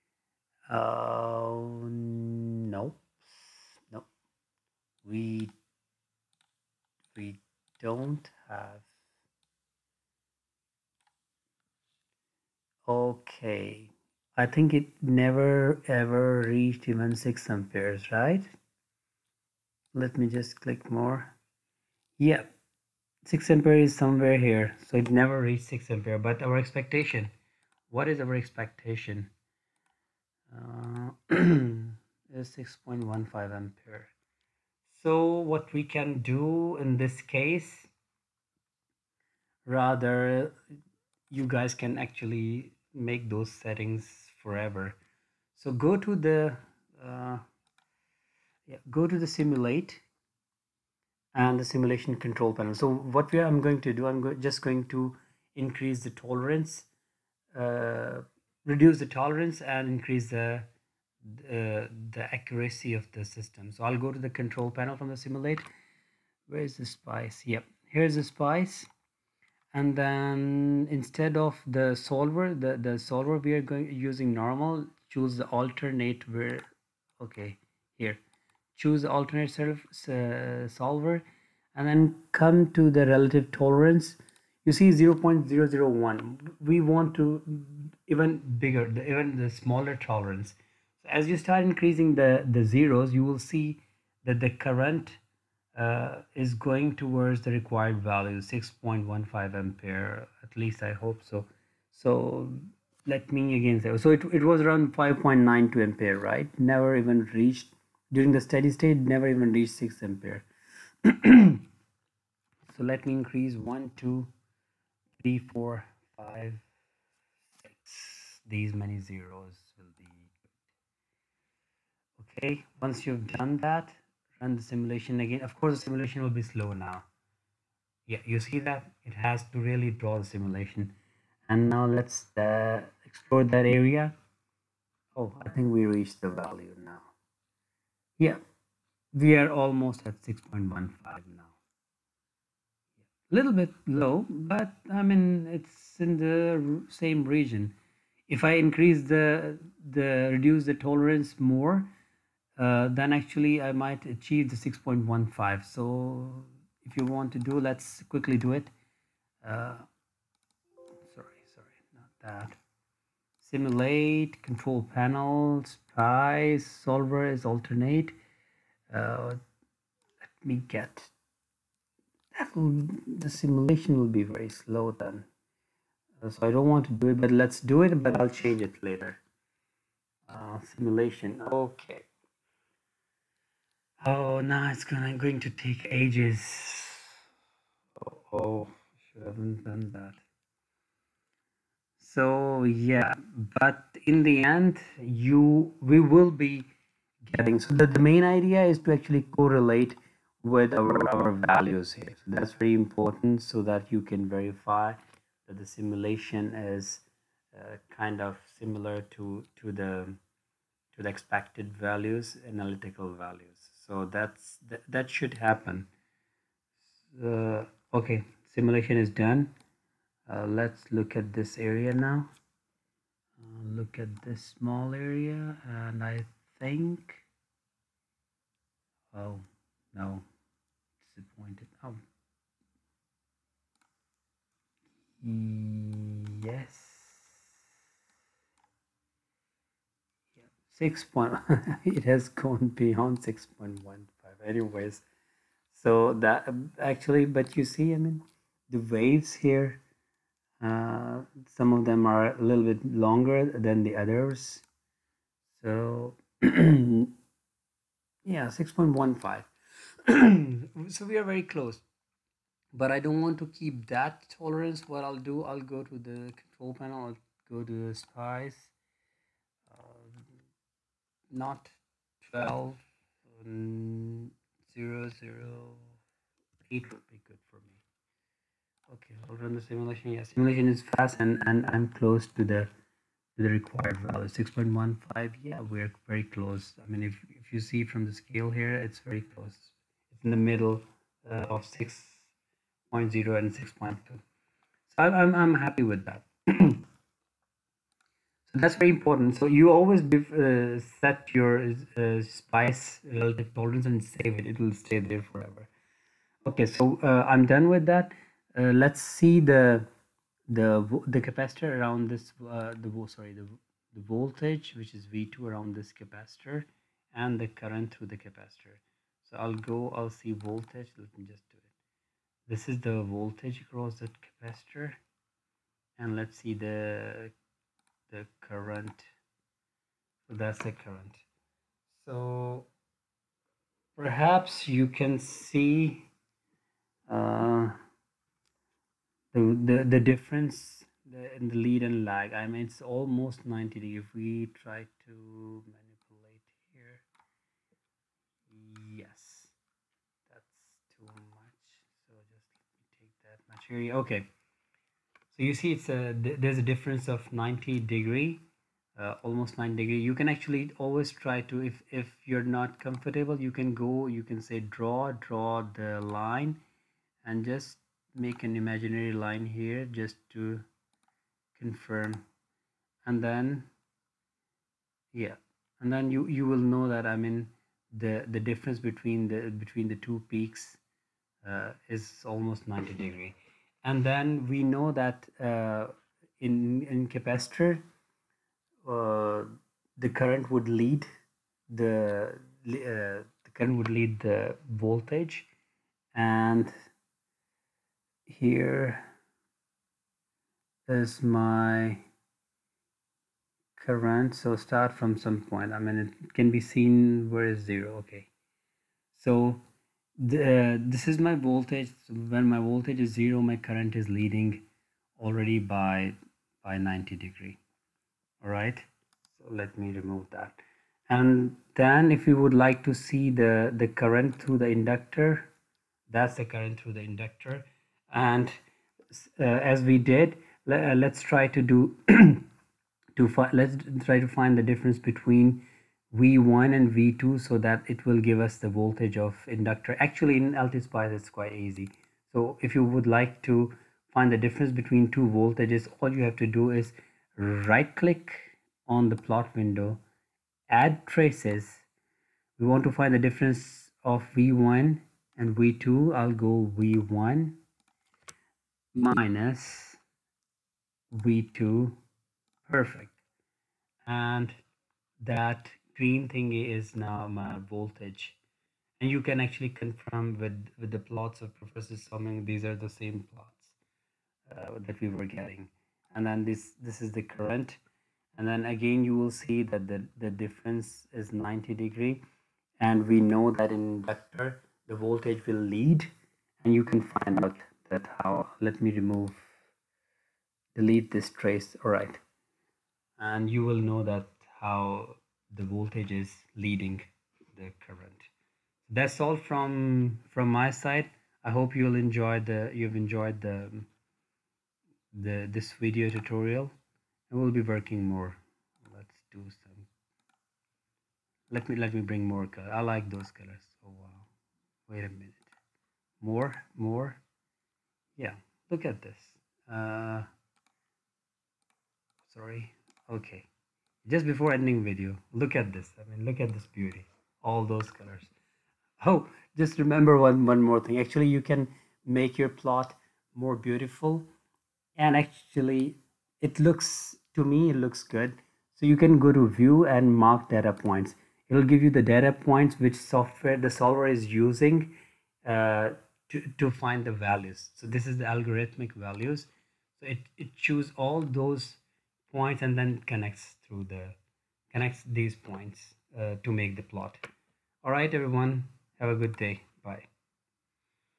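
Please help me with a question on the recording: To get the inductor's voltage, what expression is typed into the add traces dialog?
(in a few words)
V1 minus V2.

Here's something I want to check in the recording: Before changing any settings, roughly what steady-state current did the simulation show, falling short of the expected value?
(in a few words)
5.92 amperes.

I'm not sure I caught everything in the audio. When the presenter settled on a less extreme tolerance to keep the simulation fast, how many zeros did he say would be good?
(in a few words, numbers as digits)
8.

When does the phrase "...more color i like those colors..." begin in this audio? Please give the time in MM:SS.
08:32.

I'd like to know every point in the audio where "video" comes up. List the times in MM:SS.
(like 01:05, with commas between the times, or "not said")
08:25, 08:44.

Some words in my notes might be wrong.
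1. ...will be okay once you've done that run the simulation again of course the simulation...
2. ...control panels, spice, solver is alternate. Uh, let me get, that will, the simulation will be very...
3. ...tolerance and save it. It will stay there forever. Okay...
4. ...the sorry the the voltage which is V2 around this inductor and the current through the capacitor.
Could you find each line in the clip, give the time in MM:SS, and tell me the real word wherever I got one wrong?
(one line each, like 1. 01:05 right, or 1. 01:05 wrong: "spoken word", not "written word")
1. 01:59 right
2. 02:44 right
3. 05:03 right
4. 05:12 wrong: "capacitor", not "inductor".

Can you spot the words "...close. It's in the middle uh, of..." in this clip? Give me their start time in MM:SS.
04:49.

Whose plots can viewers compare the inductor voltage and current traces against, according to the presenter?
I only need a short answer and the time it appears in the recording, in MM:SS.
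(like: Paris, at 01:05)
Professor Summing, at 07:51.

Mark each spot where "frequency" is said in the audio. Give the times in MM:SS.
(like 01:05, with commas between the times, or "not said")
not said.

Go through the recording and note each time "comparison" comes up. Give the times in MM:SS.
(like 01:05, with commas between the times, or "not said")
not said.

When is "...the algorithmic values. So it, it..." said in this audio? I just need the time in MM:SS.
09:08.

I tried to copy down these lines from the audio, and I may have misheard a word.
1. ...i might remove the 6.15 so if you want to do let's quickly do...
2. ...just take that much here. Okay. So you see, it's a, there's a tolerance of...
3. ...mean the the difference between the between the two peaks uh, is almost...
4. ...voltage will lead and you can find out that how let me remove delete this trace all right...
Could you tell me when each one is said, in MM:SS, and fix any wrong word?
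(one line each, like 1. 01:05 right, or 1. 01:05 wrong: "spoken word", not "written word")
1. 02:33 wrong: "achieve", not "remove"
2. 05:52 wrong: "difference", not "tolerance"
3. 06:17 right
4. 08:04 right.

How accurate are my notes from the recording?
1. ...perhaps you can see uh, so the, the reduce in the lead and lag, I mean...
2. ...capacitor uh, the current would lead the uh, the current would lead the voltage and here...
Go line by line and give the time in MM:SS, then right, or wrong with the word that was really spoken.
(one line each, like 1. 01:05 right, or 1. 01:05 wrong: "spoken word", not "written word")
1. 05:33 wrong: "difference", not "reduce"
2. 06:27 right.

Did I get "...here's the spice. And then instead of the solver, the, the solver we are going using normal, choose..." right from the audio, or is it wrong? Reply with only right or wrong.
right.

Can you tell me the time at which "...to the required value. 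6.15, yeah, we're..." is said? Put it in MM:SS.
04:43.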